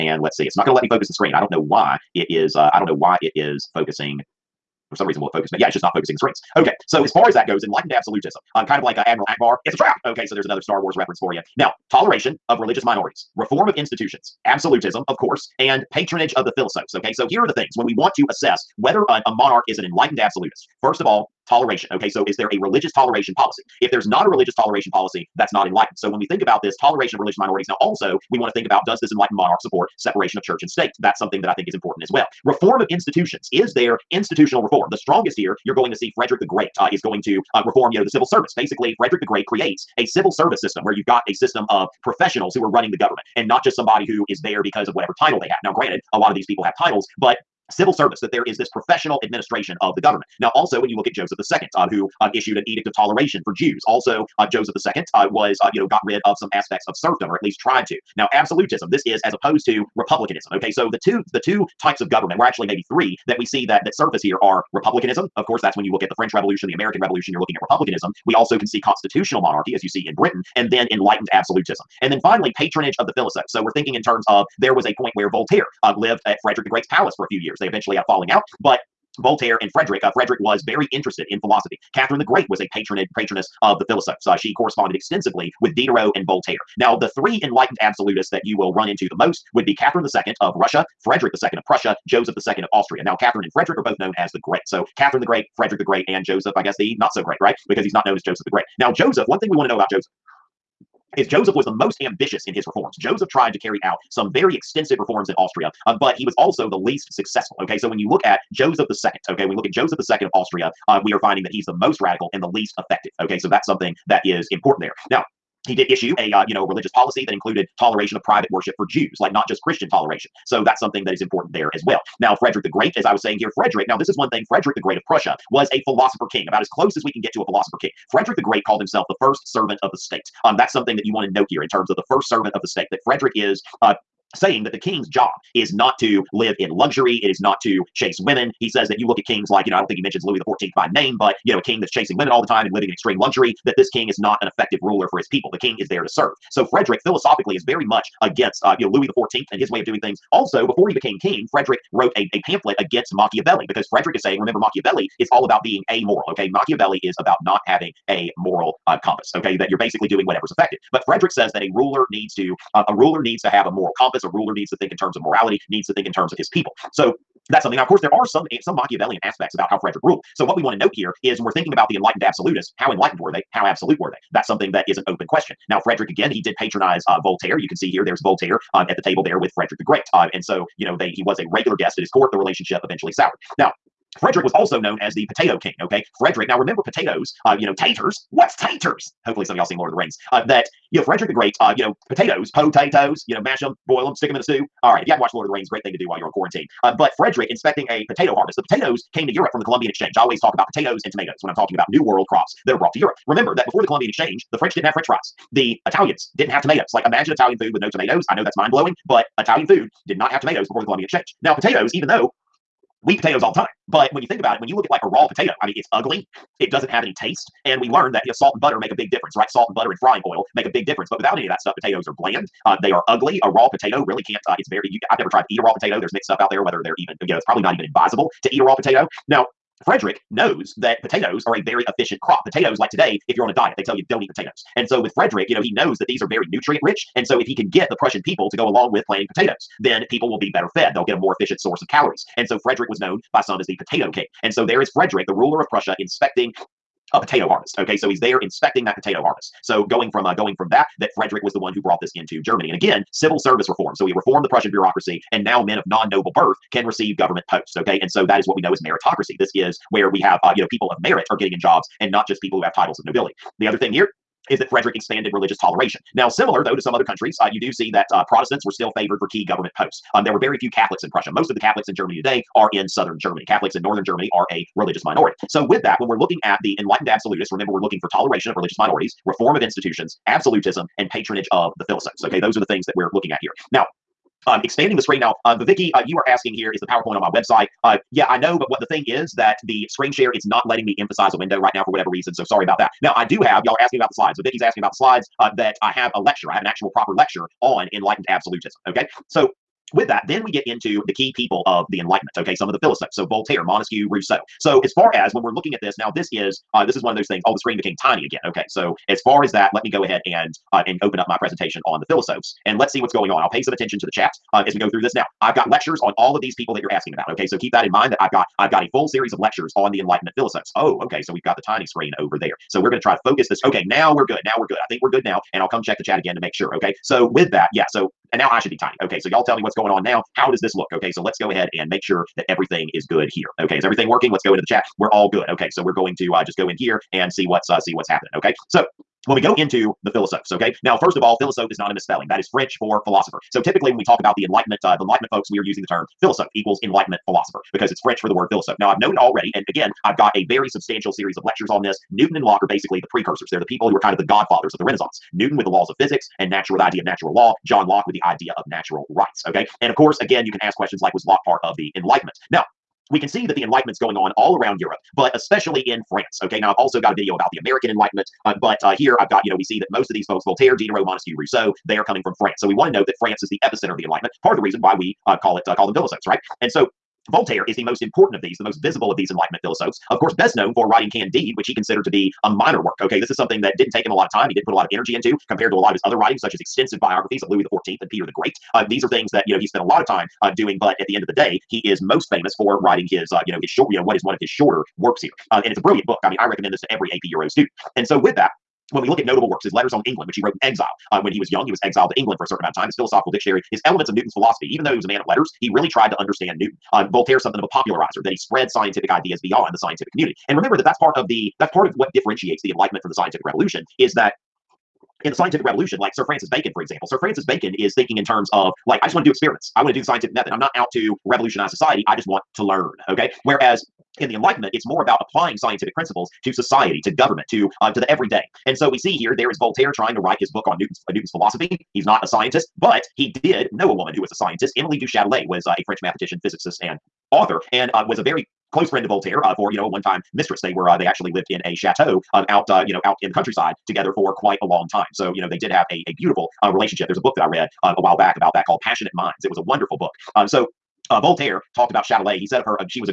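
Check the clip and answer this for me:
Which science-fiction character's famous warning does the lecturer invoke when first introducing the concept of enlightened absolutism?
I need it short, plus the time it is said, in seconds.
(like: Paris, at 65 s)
Admiral Ackbar, at 9 s.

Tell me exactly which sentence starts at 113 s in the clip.
Okay, so that's something that is important there.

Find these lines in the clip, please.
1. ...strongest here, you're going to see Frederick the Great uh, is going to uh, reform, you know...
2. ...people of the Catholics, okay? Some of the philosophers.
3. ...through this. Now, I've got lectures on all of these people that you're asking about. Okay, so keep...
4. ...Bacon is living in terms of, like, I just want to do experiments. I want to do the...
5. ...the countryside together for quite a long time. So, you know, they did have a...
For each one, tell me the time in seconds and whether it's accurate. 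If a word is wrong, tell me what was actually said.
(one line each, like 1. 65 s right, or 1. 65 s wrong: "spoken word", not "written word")
1. 34 s right
2. 301 s wrong: "Enlightenment", not "Catholics"
3. 314 s right
4. 417 s wrong: "thinking", not "living"
5. 443 s right.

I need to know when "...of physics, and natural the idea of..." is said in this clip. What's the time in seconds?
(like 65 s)
355 s.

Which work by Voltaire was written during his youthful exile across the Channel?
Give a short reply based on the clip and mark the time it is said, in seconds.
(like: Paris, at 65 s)
Letters on England, at 399 s.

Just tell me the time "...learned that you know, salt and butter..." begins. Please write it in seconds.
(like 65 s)
217 s.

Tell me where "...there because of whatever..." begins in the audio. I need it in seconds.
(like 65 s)
44 s.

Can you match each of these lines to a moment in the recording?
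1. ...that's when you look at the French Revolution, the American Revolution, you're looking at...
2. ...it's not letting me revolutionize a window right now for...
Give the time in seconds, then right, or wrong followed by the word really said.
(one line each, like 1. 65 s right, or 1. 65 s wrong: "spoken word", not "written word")
1. 65 s right
2. 290 s wrong: "emphasize", not "revolutionize".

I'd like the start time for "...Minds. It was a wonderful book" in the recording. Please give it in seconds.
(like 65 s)
449 s.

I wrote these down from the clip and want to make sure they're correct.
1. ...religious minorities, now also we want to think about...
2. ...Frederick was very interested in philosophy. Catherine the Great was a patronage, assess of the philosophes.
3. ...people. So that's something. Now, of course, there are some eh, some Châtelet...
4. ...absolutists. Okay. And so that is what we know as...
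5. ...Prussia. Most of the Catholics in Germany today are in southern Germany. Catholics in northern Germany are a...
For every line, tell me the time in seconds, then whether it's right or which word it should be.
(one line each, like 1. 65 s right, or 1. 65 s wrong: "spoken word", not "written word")
1. 27 s right
2. 80 s wrong: "patroness", not "assess"
3. 166 s wrong: "Machiavellian", not "Châtelet"
4. 257 s wrong: "posts", not "absolutists"
5. 271 s right.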